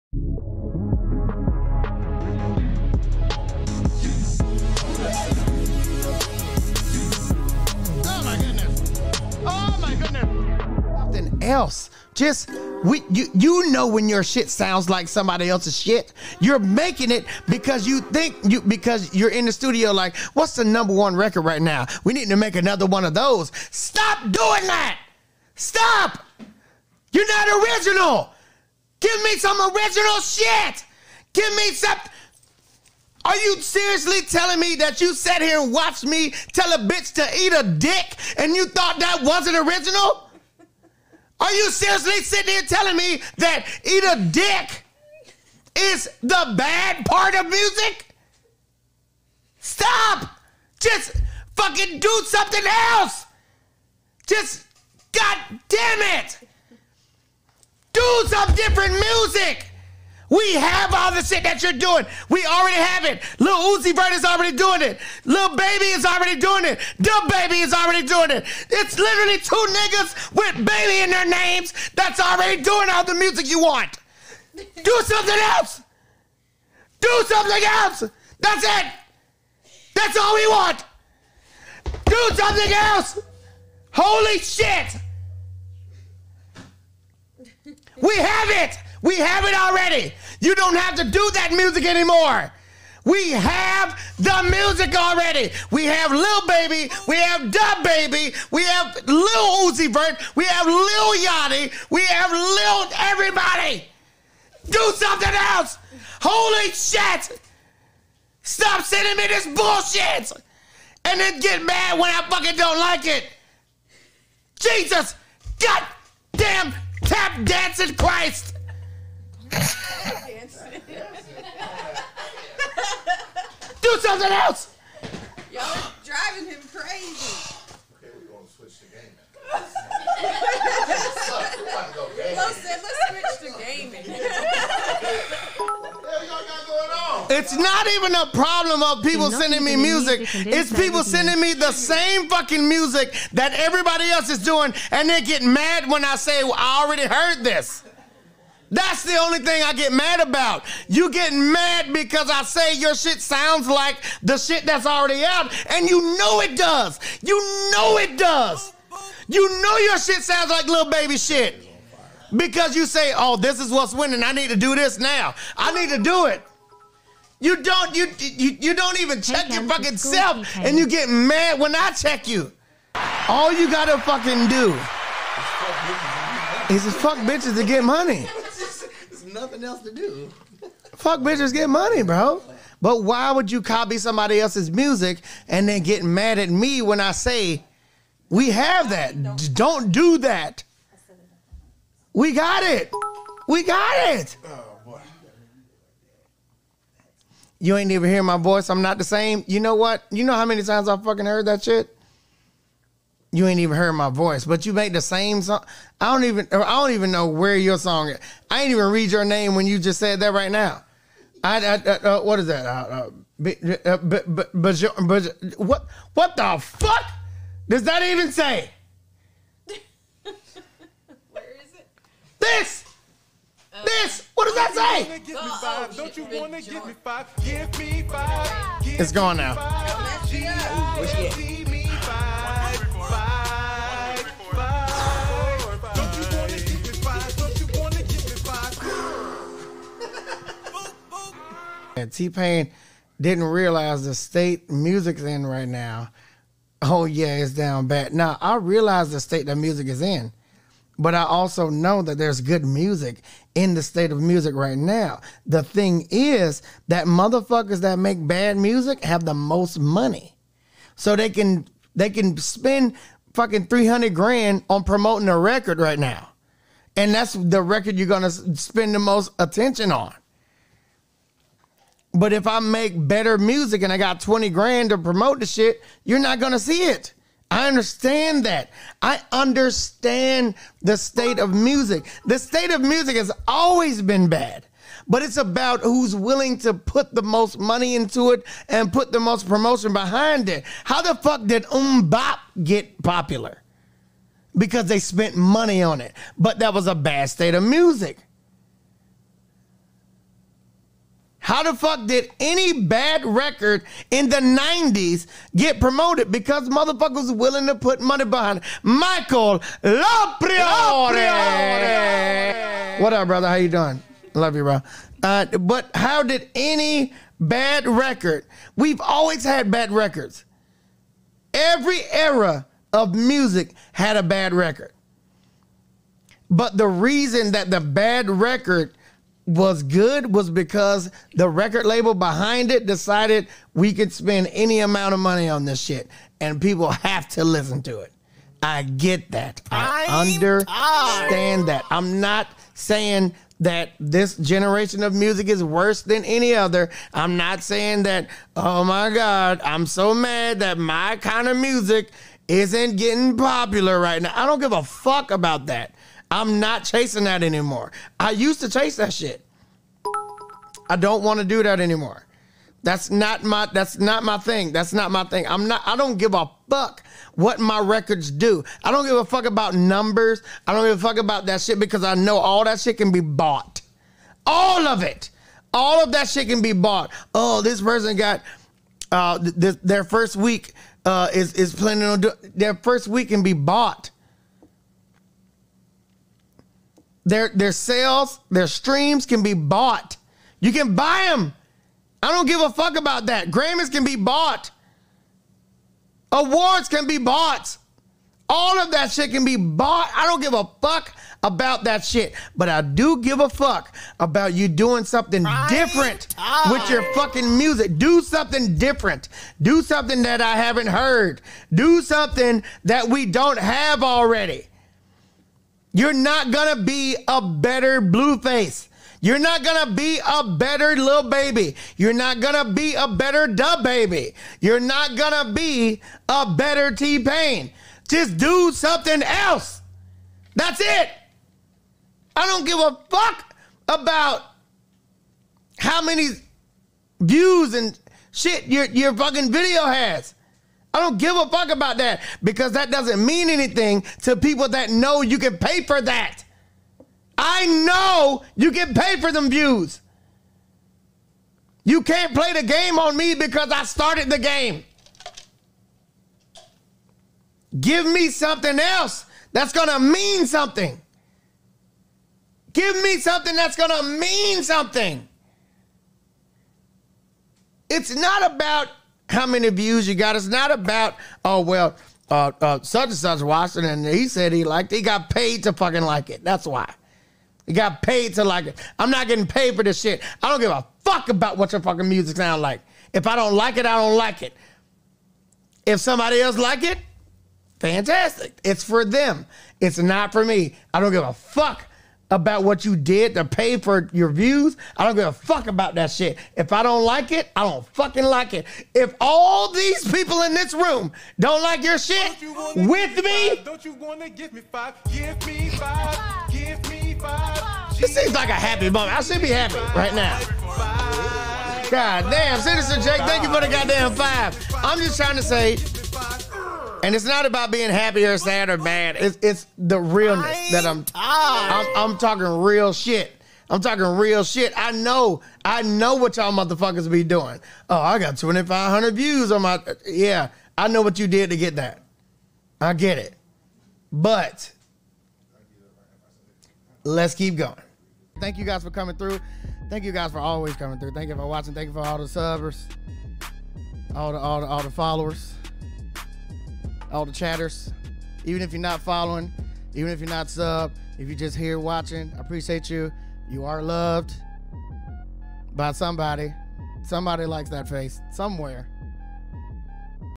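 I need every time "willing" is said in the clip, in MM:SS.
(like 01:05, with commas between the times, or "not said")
04:46, 05:07.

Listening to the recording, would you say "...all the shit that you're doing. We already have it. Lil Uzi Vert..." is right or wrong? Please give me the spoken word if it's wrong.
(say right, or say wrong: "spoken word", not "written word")
right.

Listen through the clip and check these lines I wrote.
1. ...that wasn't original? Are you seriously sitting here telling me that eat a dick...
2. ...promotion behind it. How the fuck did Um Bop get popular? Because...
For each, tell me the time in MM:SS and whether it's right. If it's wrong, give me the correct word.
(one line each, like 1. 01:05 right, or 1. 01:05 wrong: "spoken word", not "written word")
1. 00:38 right
2. 04:49 right.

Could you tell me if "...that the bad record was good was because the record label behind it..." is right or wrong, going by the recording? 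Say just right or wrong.
right.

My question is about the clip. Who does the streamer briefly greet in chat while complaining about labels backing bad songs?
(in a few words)
Michael LaPriore.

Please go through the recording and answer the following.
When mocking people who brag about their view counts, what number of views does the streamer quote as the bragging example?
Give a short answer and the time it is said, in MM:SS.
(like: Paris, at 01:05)
2,500, at 08:48.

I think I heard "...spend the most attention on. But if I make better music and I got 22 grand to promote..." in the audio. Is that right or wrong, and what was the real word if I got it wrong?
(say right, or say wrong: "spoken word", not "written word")
wrong: "20", not "22".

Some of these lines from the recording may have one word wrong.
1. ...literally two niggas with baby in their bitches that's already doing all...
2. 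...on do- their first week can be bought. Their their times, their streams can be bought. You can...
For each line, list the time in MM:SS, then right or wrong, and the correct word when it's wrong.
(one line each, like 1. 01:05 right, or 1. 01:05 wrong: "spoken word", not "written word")
1. 01:08 wrong: "names", not "bitches"
2. 06:22 wrong: "sales", not "times".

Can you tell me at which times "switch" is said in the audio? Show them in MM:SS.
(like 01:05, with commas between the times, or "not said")
02:08, 02:13.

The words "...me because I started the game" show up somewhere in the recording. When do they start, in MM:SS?
07:33.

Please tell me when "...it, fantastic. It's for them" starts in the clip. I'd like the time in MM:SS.
08:06.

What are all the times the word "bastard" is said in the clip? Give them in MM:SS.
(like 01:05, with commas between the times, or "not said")
not said.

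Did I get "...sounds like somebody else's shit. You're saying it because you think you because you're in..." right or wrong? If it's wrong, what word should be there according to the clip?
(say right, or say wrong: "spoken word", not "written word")
wrong: "making", not "saying".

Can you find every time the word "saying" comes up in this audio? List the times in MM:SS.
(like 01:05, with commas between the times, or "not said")
05:42, 05:47.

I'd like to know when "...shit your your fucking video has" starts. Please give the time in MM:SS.
07:18.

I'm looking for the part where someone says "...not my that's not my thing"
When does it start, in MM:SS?
06:03.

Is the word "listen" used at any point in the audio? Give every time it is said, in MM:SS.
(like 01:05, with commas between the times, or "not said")
05:37.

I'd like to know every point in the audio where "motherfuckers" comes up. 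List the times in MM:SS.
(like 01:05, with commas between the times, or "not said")
04:17, 05:06, 08:46.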